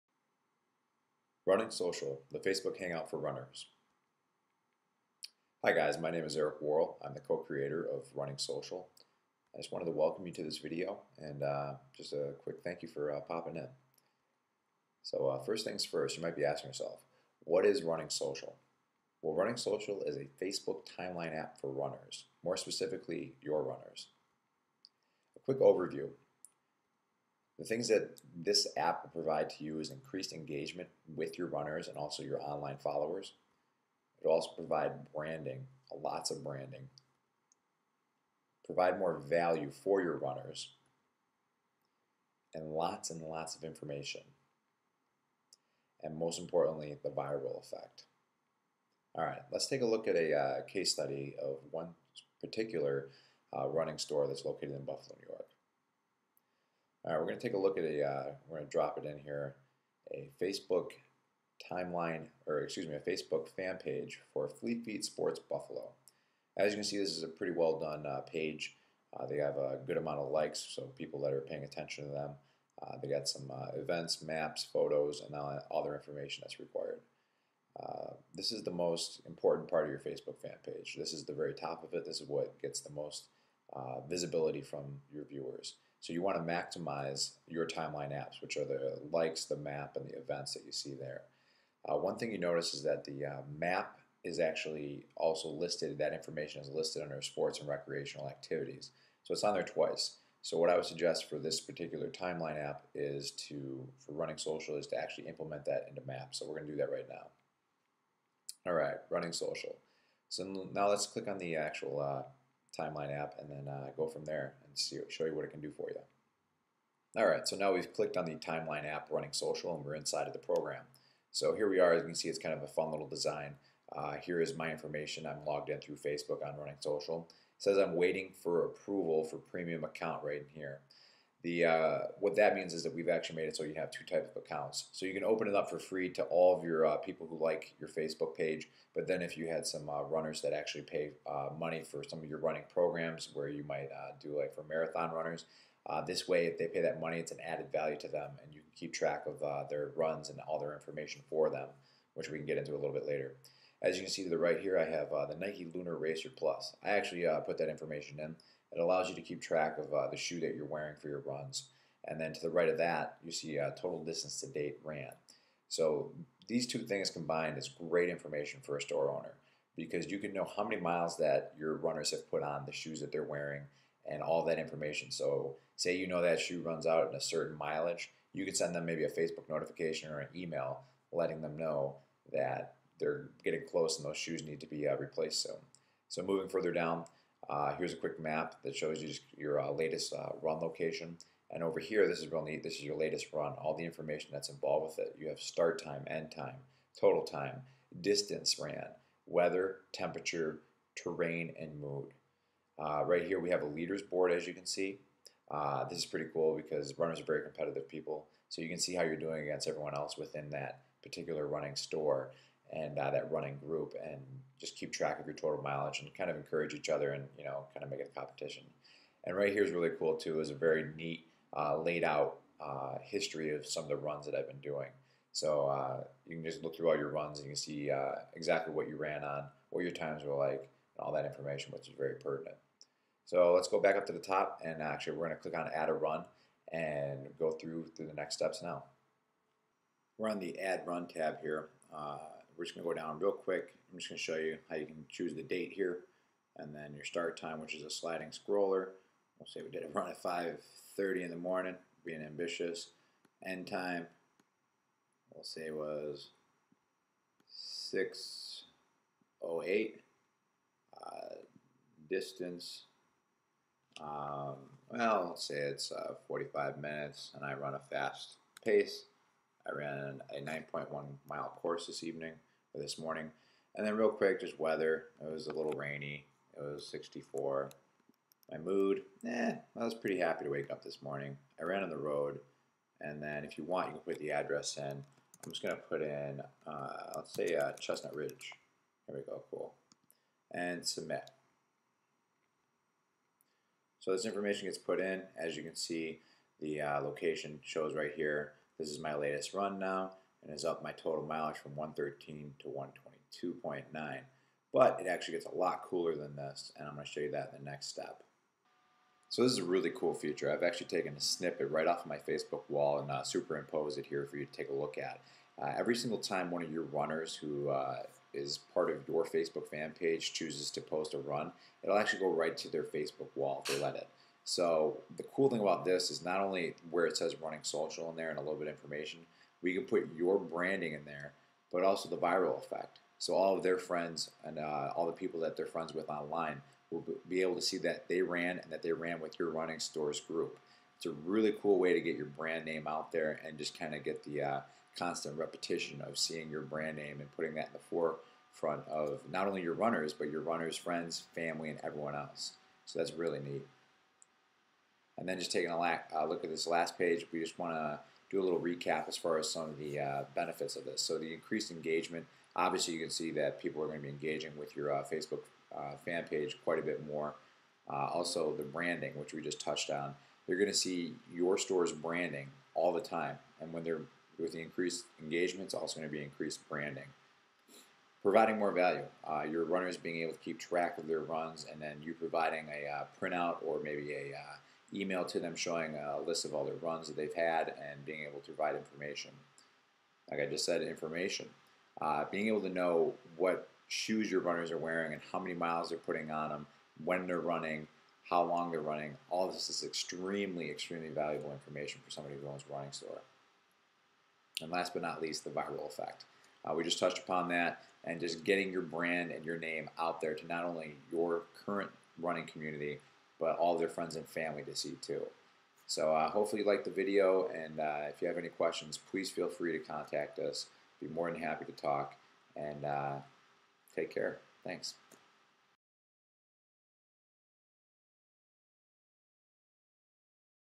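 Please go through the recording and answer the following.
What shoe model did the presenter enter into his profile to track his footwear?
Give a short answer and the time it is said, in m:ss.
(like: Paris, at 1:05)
Nike Lunar Racer Plus, at 2:35.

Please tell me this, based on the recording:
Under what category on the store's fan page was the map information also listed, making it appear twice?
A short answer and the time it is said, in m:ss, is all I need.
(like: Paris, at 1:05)
Sports and recreational activities, at 1:37.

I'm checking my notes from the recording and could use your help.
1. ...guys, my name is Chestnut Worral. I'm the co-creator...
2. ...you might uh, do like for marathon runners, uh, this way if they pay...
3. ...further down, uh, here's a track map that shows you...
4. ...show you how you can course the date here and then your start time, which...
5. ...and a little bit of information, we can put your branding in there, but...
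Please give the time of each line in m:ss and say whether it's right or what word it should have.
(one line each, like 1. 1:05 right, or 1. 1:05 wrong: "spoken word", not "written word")
1. 0:05 wrong: "Eric", not "Chestnut"
2. 2:23 right
3. 3:06 wrong: "quick", not "track"
4. 4:04 wrong: "choose", not "course"
5. 5:28 right.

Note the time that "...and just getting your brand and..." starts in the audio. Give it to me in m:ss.
6:48.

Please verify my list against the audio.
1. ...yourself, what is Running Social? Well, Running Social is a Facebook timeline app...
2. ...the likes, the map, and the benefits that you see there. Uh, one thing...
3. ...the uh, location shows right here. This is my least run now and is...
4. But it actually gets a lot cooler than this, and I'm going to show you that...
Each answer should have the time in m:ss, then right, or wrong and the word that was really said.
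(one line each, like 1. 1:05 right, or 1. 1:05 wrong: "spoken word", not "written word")
1. 0:16 right
2. 1:28 wrong: "events", not "benefits"
3. 4:56 wrong: "latest", not "least"
4. 5:04 right.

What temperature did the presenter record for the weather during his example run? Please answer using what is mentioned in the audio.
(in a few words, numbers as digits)
64.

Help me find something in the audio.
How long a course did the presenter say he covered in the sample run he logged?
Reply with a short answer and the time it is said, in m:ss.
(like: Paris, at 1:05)
9.1 miles, at 4:30.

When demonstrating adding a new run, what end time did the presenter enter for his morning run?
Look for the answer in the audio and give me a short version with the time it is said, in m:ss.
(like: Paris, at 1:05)
6:08, at 4:17.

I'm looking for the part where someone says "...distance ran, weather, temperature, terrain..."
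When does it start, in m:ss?
3:17.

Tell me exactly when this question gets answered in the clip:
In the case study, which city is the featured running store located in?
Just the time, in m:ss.
0:54.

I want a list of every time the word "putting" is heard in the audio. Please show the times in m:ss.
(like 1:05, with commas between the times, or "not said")
5:47, 6:35.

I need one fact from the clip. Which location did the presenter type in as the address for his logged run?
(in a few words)
Chestnut Ridge.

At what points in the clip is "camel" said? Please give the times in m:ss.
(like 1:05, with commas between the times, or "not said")
not said.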